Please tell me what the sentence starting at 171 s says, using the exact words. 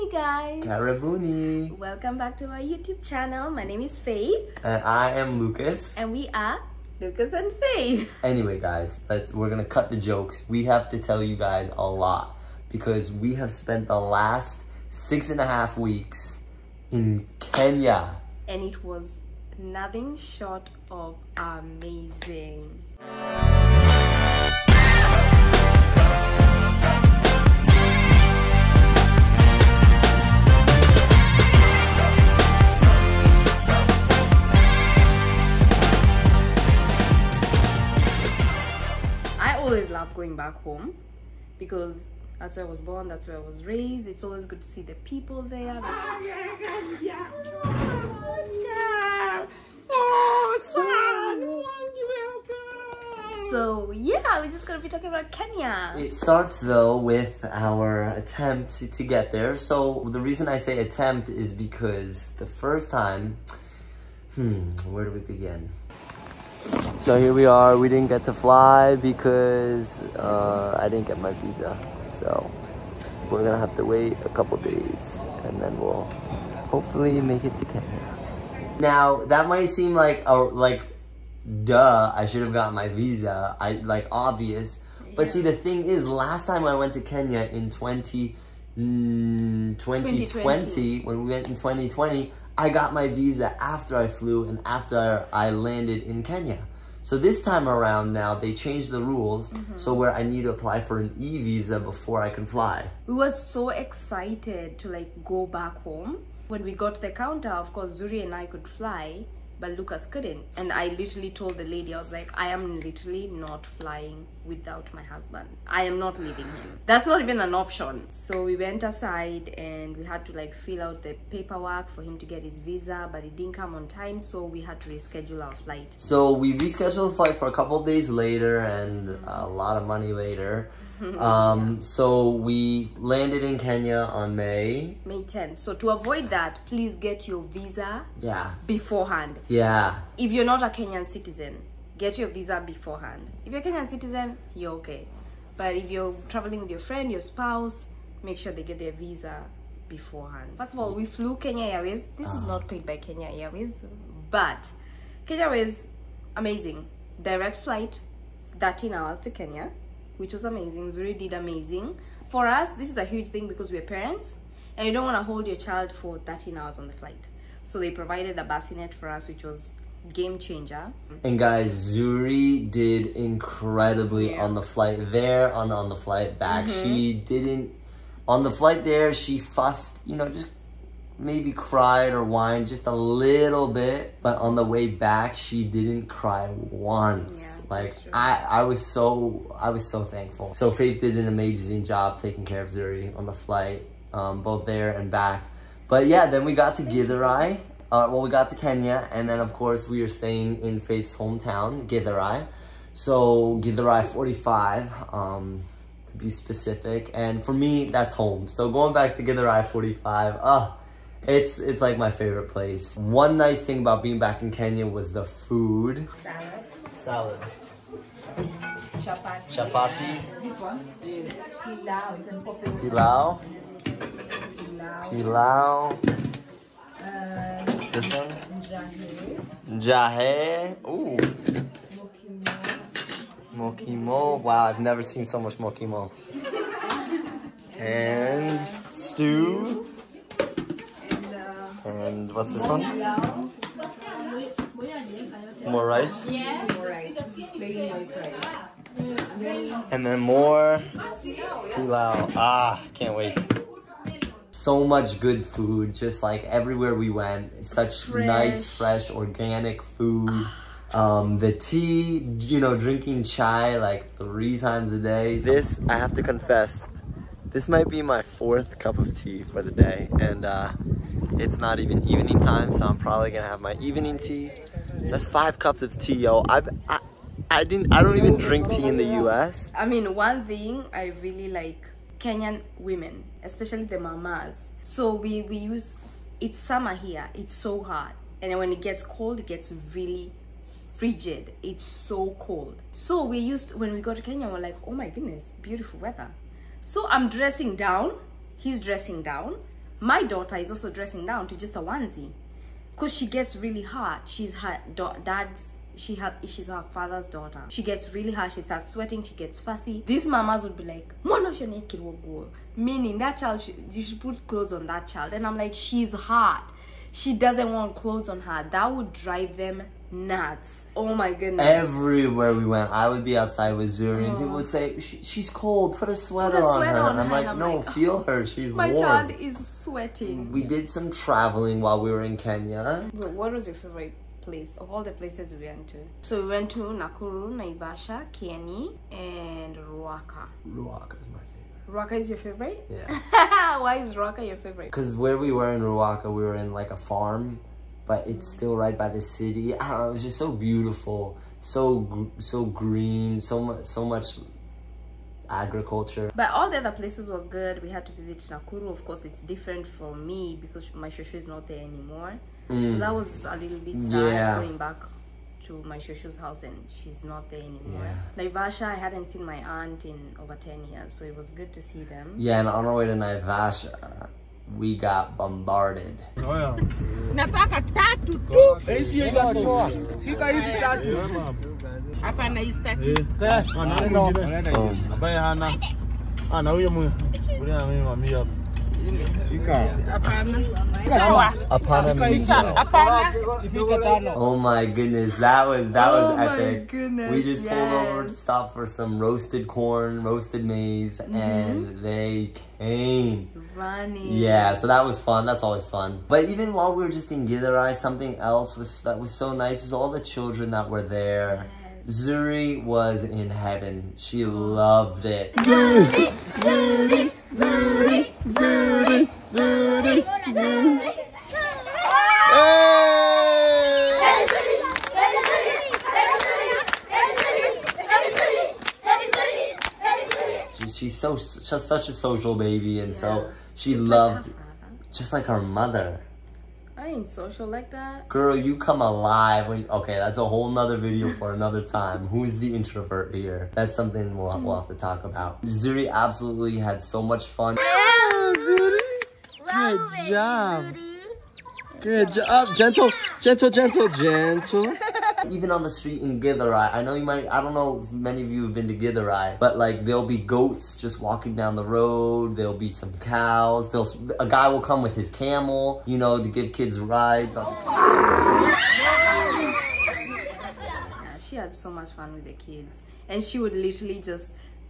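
And guys, Zuri did incredibly yeah.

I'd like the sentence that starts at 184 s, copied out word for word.
But on the way back, she didn't cry once.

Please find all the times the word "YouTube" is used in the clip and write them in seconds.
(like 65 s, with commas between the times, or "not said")
2 s.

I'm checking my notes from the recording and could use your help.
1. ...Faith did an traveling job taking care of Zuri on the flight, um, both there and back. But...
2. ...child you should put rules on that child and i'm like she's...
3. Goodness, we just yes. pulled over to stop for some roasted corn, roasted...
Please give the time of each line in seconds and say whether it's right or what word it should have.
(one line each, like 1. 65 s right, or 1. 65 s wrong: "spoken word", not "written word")
1. 190 s wrong: "amazing", not "traveling"
2. 313 s wrong: "clothes", not "rules"
3. 396 s right.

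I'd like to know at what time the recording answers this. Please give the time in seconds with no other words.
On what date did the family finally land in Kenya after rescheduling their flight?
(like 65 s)
135 s.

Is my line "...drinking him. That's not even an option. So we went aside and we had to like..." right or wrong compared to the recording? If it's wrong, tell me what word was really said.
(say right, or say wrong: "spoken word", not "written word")
wrong: "leaving", not "drinking".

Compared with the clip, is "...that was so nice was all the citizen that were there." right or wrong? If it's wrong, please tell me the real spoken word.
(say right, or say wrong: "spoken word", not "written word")
wrong: "children", not "citizen".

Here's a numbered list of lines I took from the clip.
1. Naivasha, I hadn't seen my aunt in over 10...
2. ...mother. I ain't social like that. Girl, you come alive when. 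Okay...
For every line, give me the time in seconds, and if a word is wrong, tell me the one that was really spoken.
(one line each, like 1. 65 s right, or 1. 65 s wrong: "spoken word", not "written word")
1. 368 s right
2. 435 s right.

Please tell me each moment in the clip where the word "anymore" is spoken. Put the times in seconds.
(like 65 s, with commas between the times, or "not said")
361 s, 367 s.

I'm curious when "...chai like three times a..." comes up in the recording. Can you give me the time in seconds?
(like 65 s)
263 s.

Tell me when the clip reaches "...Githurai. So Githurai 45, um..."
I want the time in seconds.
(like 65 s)
201 s.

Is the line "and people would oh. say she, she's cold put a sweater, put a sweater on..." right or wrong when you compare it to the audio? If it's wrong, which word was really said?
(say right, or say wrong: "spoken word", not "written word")
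right.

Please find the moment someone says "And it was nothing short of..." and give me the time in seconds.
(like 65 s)
18 s.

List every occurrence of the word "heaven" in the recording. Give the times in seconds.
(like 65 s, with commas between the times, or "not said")
413 s.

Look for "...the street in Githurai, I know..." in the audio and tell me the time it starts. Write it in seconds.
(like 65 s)
455 s.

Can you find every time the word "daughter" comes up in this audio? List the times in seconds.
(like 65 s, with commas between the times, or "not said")
300 s, 307 s.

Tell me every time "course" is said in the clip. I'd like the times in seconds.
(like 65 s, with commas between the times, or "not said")
107 s, 199 s, 359 s.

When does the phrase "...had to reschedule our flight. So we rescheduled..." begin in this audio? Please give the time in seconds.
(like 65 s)
124 s.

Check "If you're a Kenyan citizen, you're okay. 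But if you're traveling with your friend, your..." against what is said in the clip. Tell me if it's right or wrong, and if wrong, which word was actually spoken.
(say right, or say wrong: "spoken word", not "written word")
right.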